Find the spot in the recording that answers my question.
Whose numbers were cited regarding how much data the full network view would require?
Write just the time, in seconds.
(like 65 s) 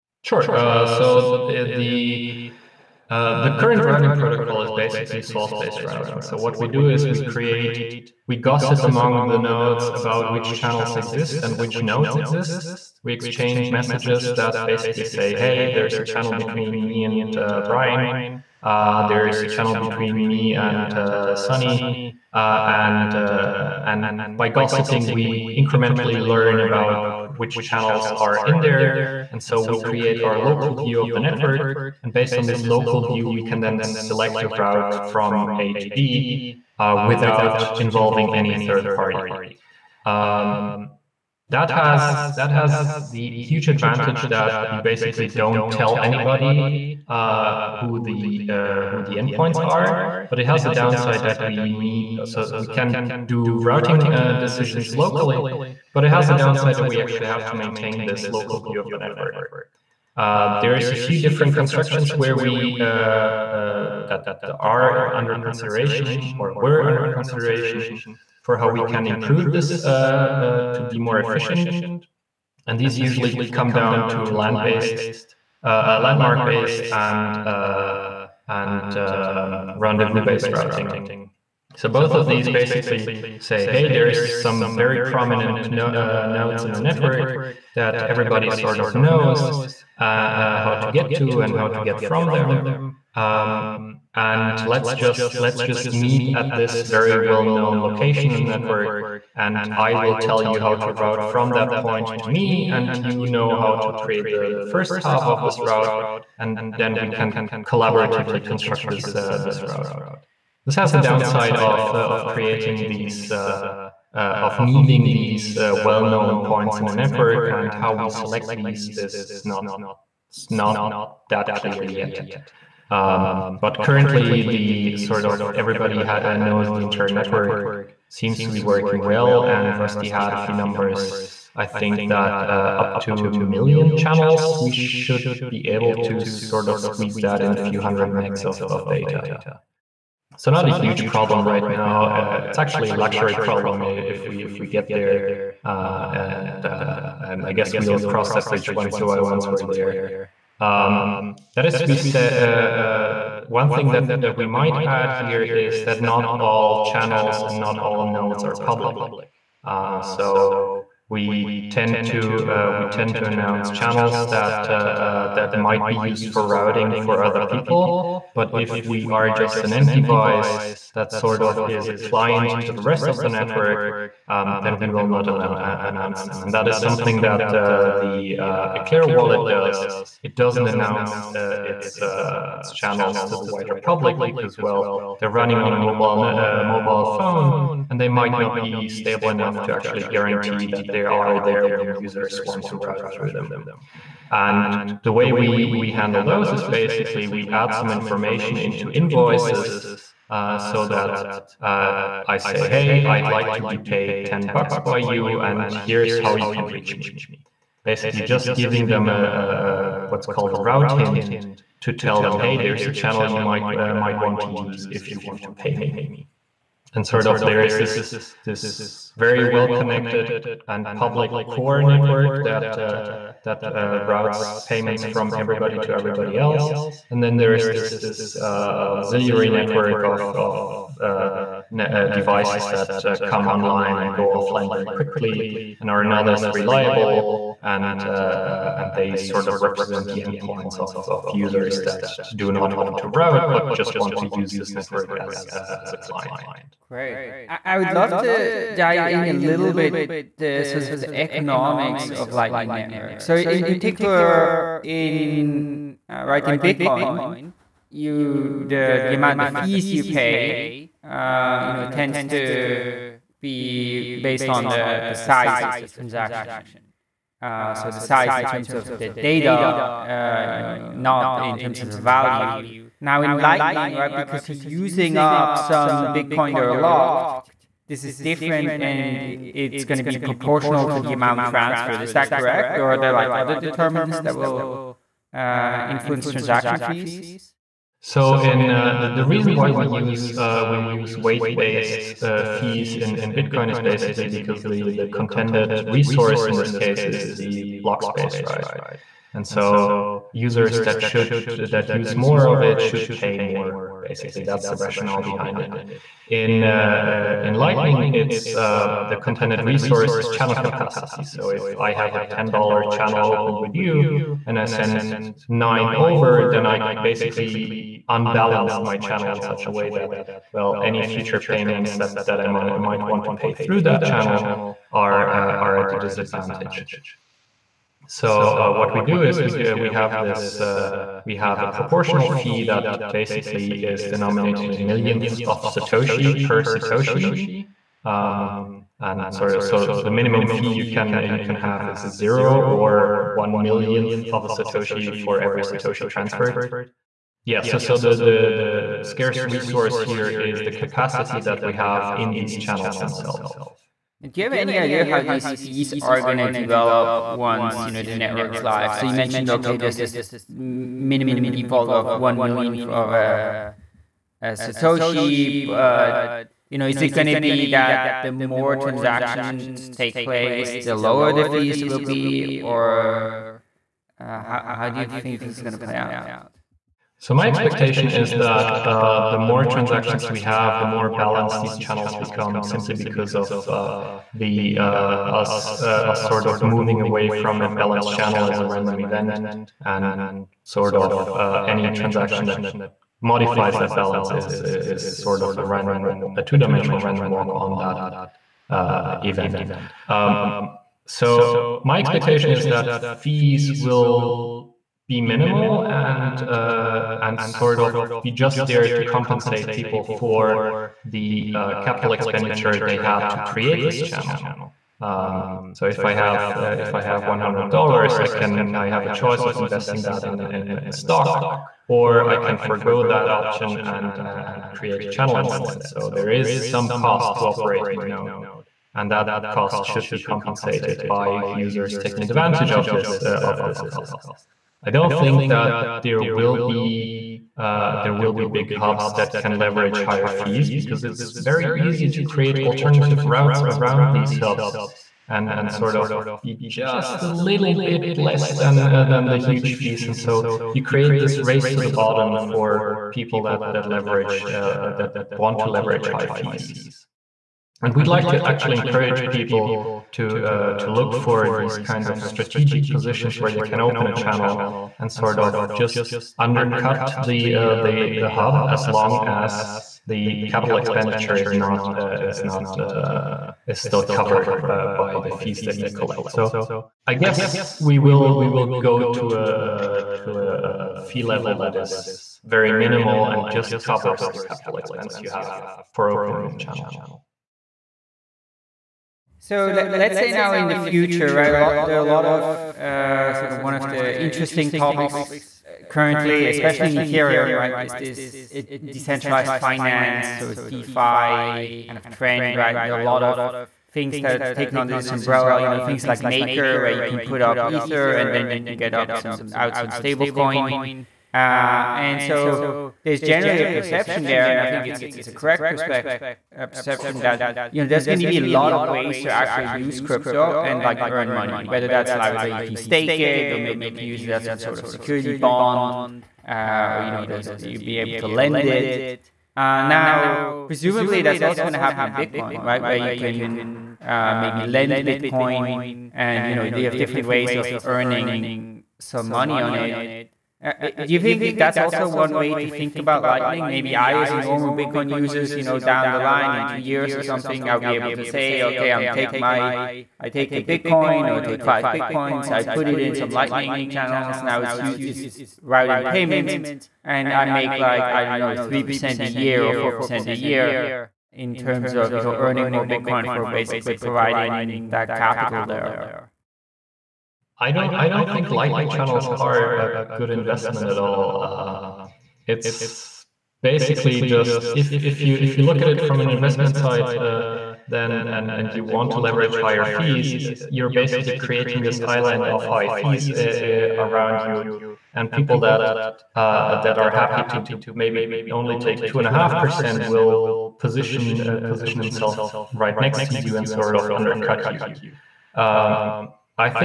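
129 s.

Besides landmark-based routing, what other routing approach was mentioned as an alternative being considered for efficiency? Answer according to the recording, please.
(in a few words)
Rendezvous based routing.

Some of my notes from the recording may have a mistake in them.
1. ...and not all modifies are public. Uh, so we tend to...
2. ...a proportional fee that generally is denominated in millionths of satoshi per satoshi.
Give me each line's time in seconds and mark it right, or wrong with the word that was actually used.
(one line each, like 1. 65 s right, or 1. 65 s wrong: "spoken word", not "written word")
1. 157 s wrong: "nodes", not "modifies"
2. 331 s wrong: "basically", not "generally".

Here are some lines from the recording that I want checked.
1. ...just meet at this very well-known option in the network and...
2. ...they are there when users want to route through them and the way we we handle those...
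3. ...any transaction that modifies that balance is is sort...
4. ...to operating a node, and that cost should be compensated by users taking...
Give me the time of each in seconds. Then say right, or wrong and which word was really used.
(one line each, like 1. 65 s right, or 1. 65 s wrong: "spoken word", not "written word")
1. 95 s wrong: "location", not "option"
2. 190 s right
3. 391 s right
4. 427 s right.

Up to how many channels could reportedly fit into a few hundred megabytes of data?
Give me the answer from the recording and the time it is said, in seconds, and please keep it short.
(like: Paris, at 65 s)
1 million, at 133 s.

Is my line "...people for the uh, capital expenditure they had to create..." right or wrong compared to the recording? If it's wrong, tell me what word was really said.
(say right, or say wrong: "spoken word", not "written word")
right.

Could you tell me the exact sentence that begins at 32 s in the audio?
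And based on this local view, we can then select a route from A to B uh, without involving any third party.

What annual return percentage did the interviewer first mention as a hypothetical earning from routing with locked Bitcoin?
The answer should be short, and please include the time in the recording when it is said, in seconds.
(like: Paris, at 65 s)
3 percent, at 558 s.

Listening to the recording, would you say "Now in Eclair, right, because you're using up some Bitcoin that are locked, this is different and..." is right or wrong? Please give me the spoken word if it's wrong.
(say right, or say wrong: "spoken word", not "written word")
wrong: "Lightning", not "Eclair".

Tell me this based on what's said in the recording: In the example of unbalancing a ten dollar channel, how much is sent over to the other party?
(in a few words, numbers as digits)
9 dollars.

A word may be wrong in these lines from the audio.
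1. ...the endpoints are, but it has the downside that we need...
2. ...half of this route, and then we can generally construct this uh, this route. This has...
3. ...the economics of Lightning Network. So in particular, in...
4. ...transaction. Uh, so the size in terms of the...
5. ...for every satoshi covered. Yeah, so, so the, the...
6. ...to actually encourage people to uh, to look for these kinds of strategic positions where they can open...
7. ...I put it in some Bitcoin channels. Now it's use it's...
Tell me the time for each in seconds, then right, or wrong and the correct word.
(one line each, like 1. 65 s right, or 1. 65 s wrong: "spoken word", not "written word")
1. 49 s right
2. 104 s wrong: "collaboratively", not "generally"
3. 250 s right
4. 265 s right
5. 345 s wrong: "transferred", not "covered"
6. 458 s right
7. 552 s wrong: "Lightning", not "Bitcoin".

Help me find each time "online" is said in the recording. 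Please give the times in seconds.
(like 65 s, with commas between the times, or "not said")
233 s.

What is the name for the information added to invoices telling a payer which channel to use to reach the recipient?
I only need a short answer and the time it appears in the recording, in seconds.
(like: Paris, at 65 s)
Route hint, at 210 s.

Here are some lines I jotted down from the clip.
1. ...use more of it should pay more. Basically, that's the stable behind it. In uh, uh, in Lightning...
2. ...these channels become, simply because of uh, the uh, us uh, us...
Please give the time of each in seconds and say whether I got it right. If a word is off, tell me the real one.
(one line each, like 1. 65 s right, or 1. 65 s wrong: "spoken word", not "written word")
1. 301 s wrong: "rationale", not "stable"
2. 381 s right.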